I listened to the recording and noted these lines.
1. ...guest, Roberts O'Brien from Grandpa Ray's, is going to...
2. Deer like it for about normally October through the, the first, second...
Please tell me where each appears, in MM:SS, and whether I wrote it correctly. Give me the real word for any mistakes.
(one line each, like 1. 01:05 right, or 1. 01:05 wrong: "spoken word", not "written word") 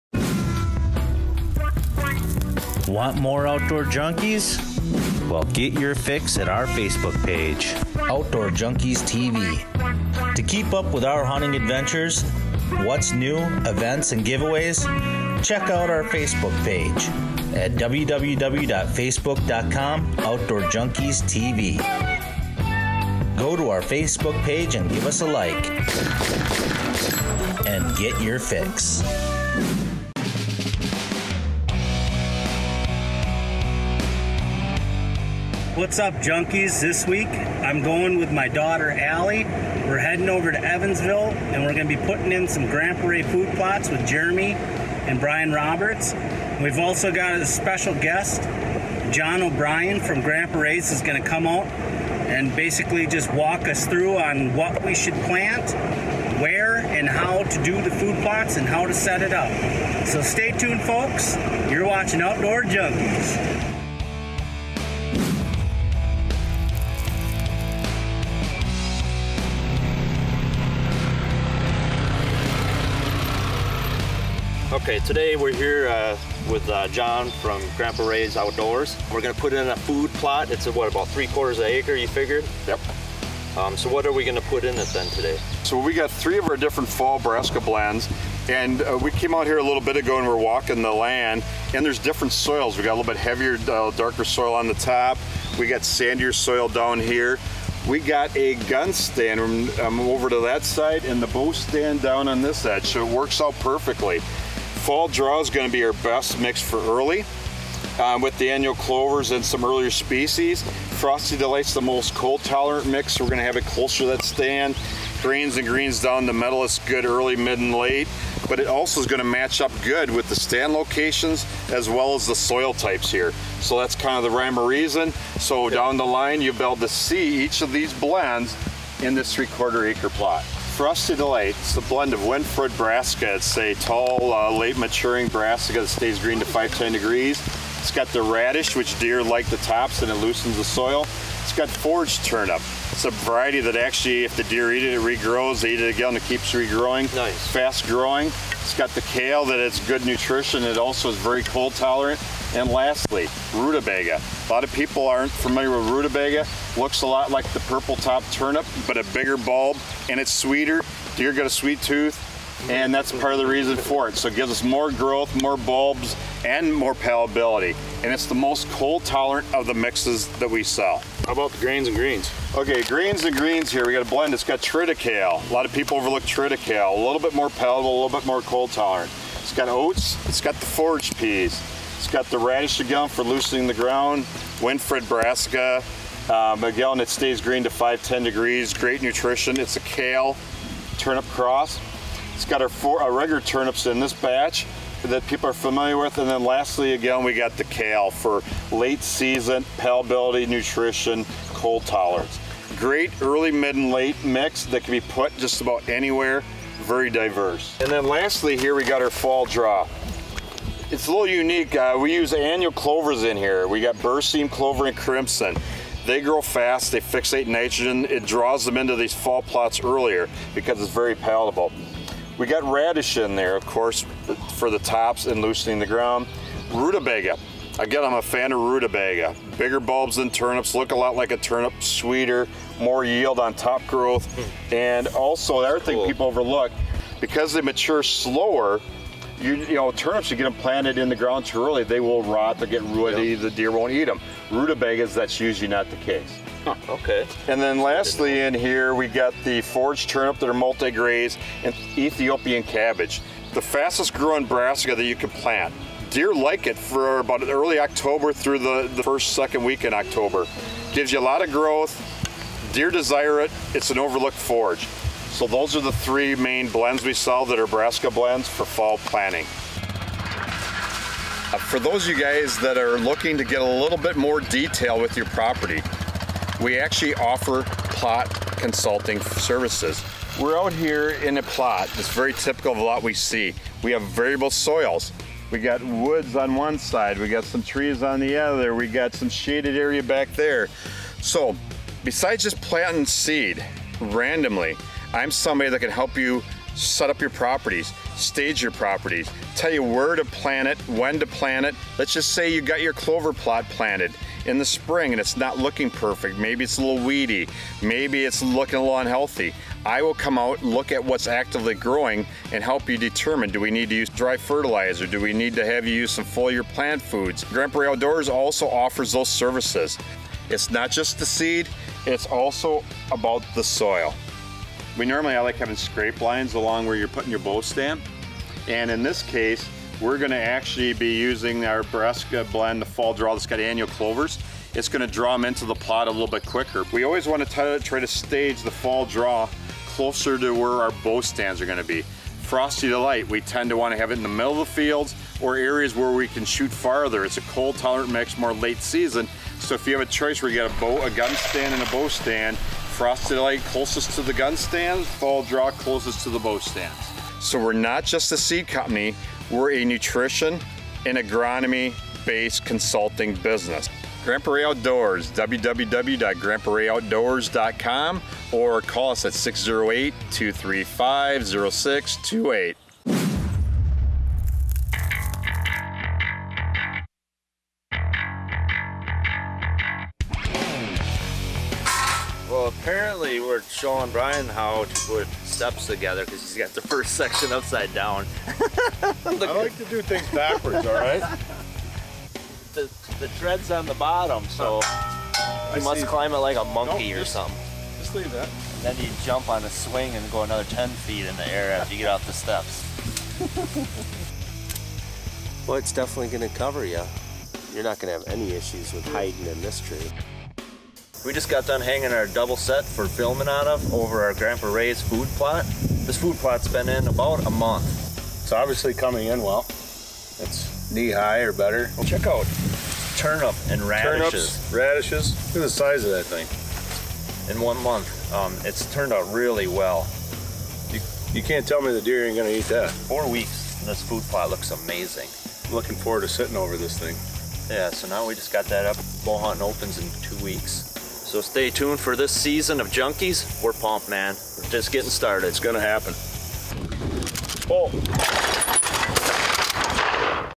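1. 00:47 wrong: "John", not "Roberts"
2. 04:16 wrong: "early", not "normally".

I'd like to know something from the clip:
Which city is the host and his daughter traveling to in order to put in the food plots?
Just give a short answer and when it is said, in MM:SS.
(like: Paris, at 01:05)
Evansville, at 00:40.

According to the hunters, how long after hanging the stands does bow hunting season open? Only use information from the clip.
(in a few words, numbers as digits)
2 weeks.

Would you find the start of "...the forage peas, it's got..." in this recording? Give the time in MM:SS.
03:00.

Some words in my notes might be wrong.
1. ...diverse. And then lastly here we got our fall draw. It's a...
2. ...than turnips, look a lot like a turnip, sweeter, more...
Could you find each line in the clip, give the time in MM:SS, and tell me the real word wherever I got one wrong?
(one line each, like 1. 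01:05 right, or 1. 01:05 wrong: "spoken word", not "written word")
1. 03:27 right
2. 03:50 right.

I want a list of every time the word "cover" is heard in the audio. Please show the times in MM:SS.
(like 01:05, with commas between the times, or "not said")
06:46.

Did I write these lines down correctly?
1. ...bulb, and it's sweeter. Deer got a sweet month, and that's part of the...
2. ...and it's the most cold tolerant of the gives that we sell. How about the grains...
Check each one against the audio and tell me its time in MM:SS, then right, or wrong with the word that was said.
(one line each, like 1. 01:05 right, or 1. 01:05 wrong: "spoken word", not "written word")
1. 02:39 wrong: "tooth", not "month"
2. 02:48 wrong: "mixes", not "gives".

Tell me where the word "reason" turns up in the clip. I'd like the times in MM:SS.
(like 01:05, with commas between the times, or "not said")
02:04, 02:43.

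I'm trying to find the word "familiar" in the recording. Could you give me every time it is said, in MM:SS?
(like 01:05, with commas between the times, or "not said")
02:35, 03:15.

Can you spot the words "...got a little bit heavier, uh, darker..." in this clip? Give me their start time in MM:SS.
01:32.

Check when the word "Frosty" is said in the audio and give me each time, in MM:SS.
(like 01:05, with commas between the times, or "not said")
01:50, 02:10, 05:42, 05:52.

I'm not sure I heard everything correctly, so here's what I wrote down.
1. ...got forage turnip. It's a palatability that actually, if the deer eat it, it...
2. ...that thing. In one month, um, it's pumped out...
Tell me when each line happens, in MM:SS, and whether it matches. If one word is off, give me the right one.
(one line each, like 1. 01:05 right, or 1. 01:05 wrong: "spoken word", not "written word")
1. 02:21 wrong: "variety", not "palatability"
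2. 07:06 wrong: "turned", not "pumped".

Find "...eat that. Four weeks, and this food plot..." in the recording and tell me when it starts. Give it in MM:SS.
07:12.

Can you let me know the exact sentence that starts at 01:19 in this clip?
We're gonna put in a food plot.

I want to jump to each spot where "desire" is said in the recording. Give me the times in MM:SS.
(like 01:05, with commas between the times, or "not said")
04:22.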